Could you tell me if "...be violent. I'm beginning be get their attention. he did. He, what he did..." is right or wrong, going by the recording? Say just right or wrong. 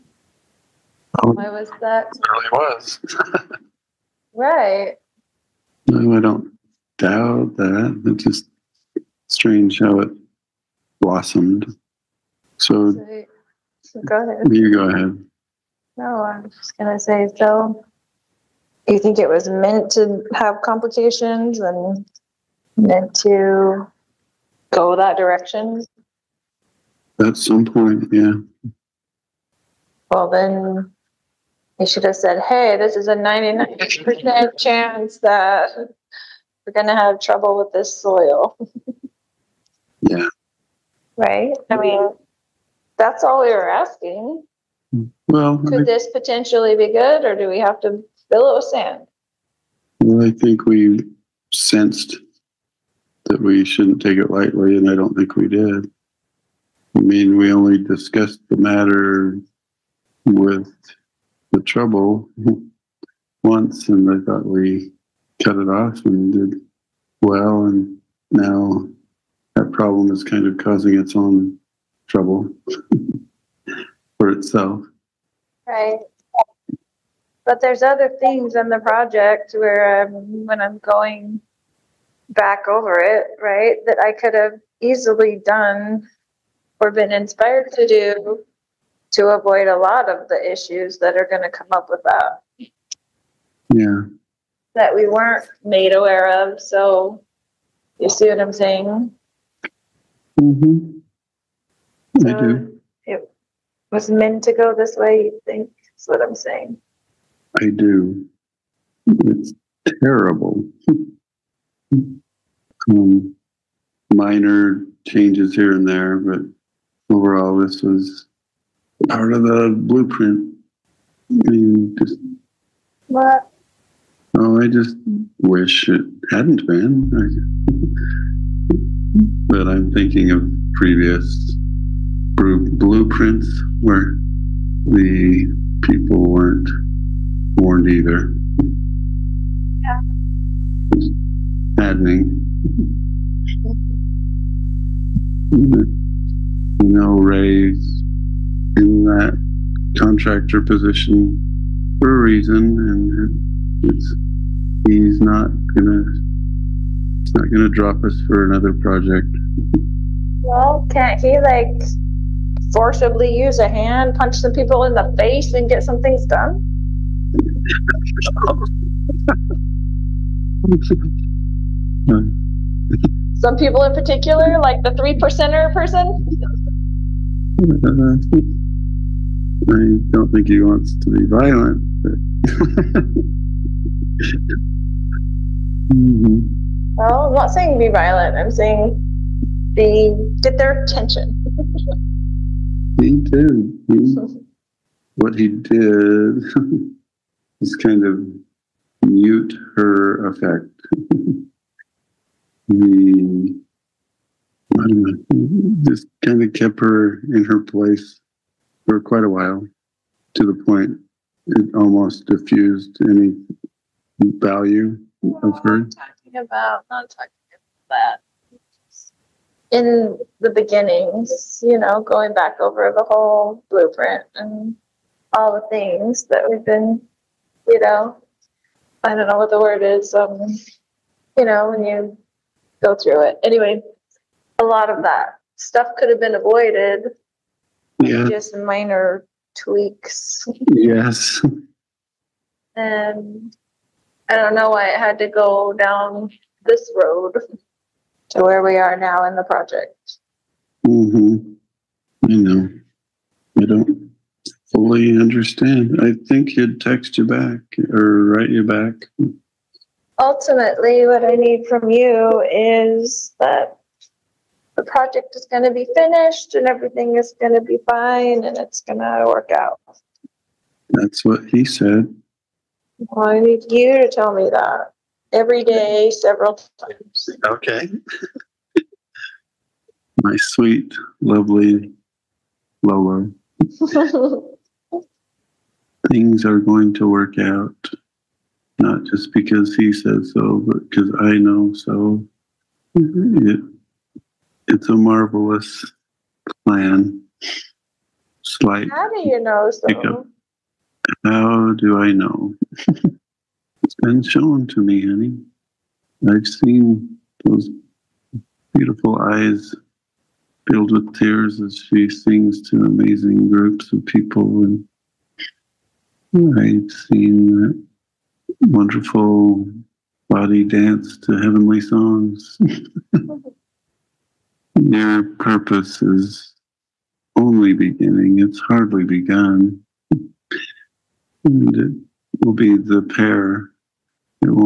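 wrong.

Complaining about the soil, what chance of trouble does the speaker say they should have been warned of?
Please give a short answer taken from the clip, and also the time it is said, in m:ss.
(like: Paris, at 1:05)
99%, at 0:33.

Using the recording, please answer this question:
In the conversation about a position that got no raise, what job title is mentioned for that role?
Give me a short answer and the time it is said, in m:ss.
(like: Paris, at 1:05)
Contractor, at 2:29.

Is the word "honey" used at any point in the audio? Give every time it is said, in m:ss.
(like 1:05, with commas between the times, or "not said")
5:05.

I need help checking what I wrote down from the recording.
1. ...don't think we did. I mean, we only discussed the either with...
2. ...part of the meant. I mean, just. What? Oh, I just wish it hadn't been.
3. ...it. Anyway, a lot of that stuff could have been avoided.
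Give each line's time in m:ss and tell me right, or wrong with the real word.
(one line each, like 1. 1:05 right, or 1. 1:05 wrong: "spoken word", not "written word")
1. 0:54 wrong: "matter", not "either"
2. 1:59 wrong: "blueprint", not "meant"
3. 3:53 right.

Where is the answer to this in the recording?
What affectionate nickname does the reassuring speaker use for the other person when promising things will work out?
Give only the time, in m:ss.
4:42.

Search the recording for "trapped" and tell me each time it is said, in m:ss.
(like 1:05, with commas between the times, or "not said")
not said.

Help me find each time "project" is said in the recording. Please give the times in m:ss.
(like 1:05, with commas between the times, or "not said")
1:18, 2:38, 4:09, 4:24.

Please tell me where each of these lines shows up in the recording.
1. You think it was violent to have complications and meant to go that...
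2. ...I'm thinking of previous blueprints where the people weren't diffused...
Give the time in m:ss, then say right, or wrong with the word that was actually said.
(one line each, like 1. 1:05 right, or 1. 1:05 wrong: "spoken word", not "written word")
1. 0:18 wrong: "meant", not "violent"
2. 2:09 wrong: "warned", not "diffused".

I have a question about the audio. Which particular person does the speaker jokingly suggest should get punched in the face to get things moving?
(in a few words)
The three percenter.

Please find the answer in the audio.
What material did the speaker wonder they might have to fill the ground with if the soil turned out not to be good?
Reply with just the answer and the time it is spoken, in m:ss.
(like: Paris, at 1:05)
Sand, at 0:48.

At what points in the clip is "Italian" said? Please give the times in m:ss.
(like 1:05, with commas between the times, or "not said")
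not said.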